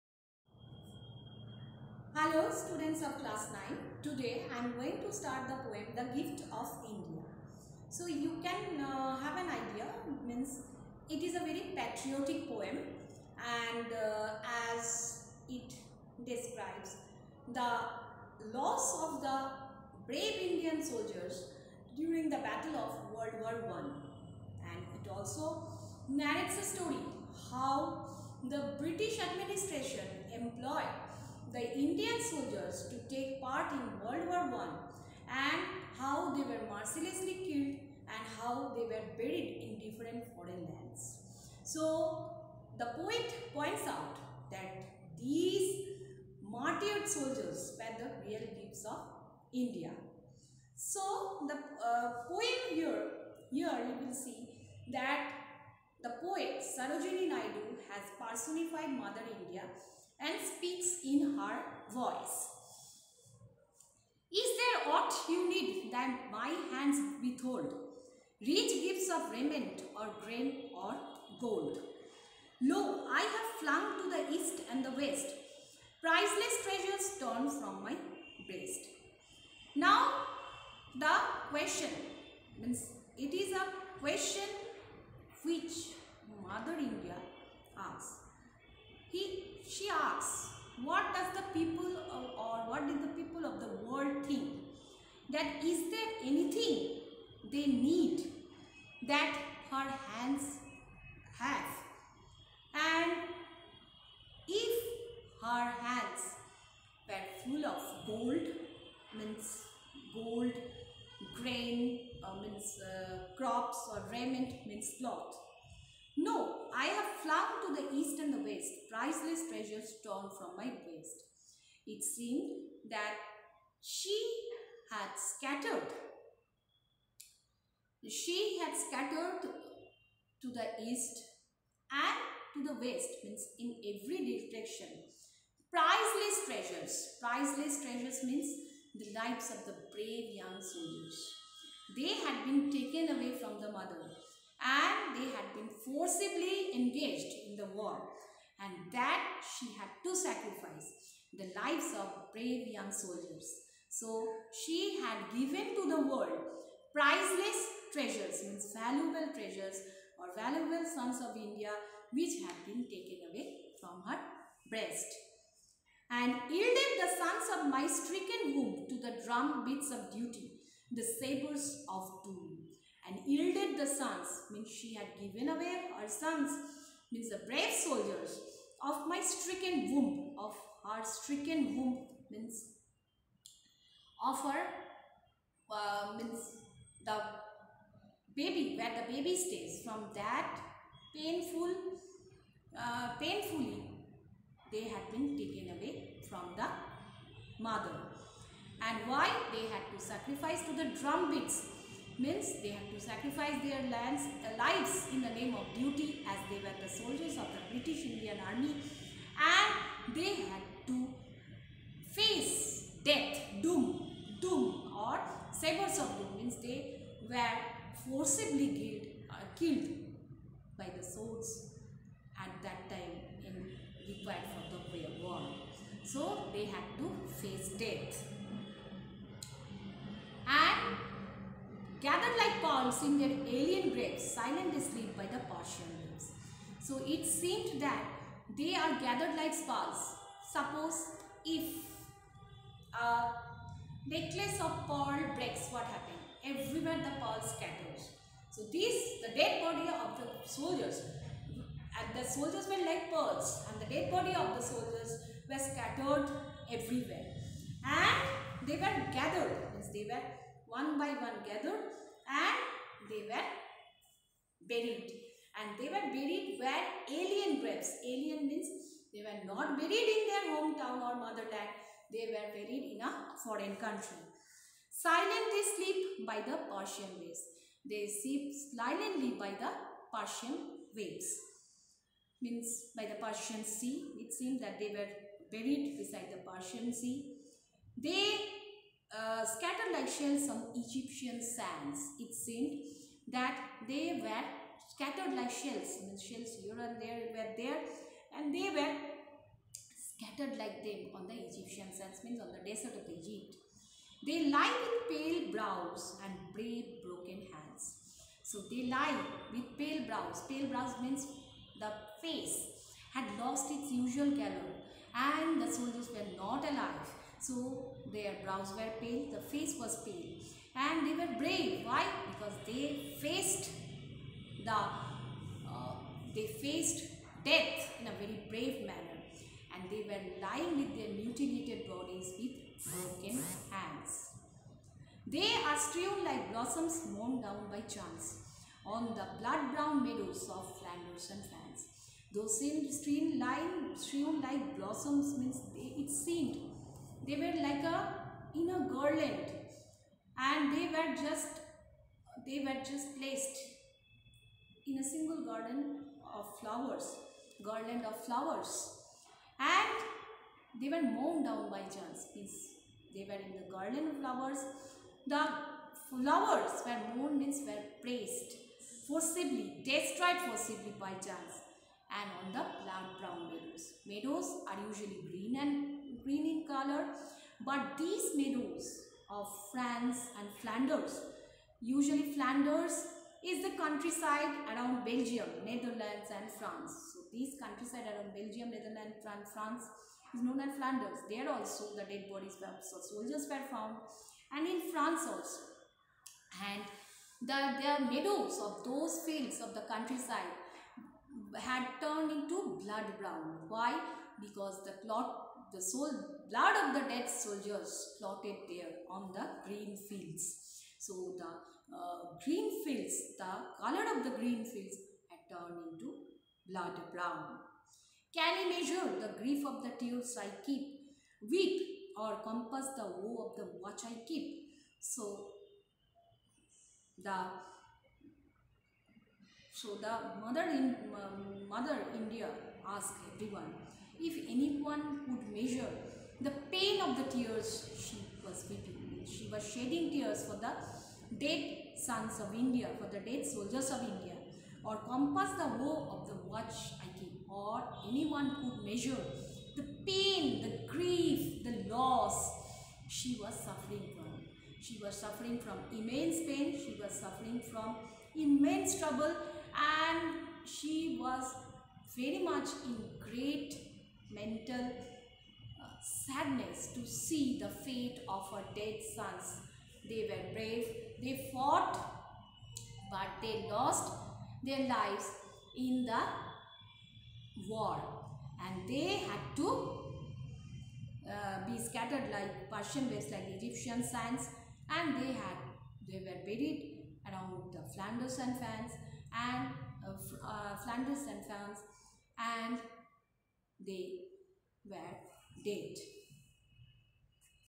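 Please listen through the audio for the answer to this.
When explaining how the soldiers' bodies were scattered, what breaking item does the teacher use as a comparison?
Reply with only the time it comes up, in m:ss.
4:04.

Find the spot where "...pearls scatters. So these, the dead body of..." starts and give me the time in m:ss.
4:07.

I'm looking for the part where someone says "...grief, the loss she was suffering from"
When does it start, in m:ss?
7:30.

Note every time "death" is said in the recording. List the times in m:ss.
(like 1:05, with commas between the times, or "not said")
3:33, 3:47, 5:27.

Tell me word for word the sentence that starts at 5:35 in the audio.
They are strewn like blossoms mown down by chance on the blood-brown meadows of Flanders and France.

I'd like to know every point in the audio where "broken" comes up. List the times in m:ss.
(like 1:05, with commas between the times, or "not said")
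5:07, 5:32.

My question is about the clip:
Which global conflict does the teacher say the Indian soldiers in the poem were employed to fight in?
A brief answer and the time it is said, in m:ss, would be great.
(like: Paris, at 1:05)
World War 1, at 0:23.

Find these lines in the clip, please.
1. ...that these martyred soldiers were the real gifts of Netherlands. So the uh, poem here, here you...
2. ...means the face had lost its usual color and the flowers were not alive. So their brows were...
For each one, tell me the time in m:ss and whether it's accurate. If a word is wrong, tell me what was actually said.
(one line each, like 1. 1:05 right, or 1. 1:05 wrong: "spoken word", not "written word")
1. 0:44 wrong: "India", not "Netherlands"
2. 5:11 wrong: "soldiers", not "flowers".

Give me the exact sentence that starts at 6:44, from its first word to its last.
Because the clot, the soul, blood of the dead soldiers plotted there on the green fields.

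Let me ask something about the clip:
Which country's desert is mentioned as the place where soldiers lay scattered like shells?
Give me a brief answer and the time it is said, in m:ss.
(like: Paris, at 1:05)
Egypt, at 5:03.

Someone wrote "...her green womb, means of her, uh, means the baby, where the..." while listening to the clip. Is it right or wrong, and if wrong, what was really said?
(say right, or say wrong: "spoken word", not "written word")
wrong: "stricken", not "green".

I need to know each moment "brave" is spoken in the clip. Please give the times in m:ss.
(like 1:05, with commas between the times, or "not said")
0:20, 2:19, 2:32, 2:57, 5:06, 5:21, 5:28, 7:50.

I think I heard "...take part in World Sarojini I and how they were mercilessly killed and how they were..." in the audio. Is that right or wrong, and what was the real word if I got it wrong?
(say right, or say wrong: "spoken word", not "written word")
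wrong: "War", not "Sarojini".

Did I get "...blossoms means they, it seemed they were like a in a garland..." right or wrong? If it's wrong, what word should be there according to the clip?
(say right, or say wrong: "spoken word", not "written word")
right.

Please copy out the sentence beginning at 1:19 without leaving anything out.
Now, the question means it is a question which Mother India asks.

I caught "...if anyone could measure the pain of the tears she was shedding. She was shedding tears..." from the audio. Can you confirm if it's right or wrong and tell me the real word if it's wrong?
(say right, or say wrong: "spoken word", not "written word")
wrong: "weeping", not "shedding".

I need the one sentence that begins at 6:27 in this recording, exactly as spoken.
So these countryside around Belgium, Netherlands and France is known as Flanders.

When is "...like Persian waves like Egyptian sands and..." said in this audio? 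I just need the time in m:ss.
8:02.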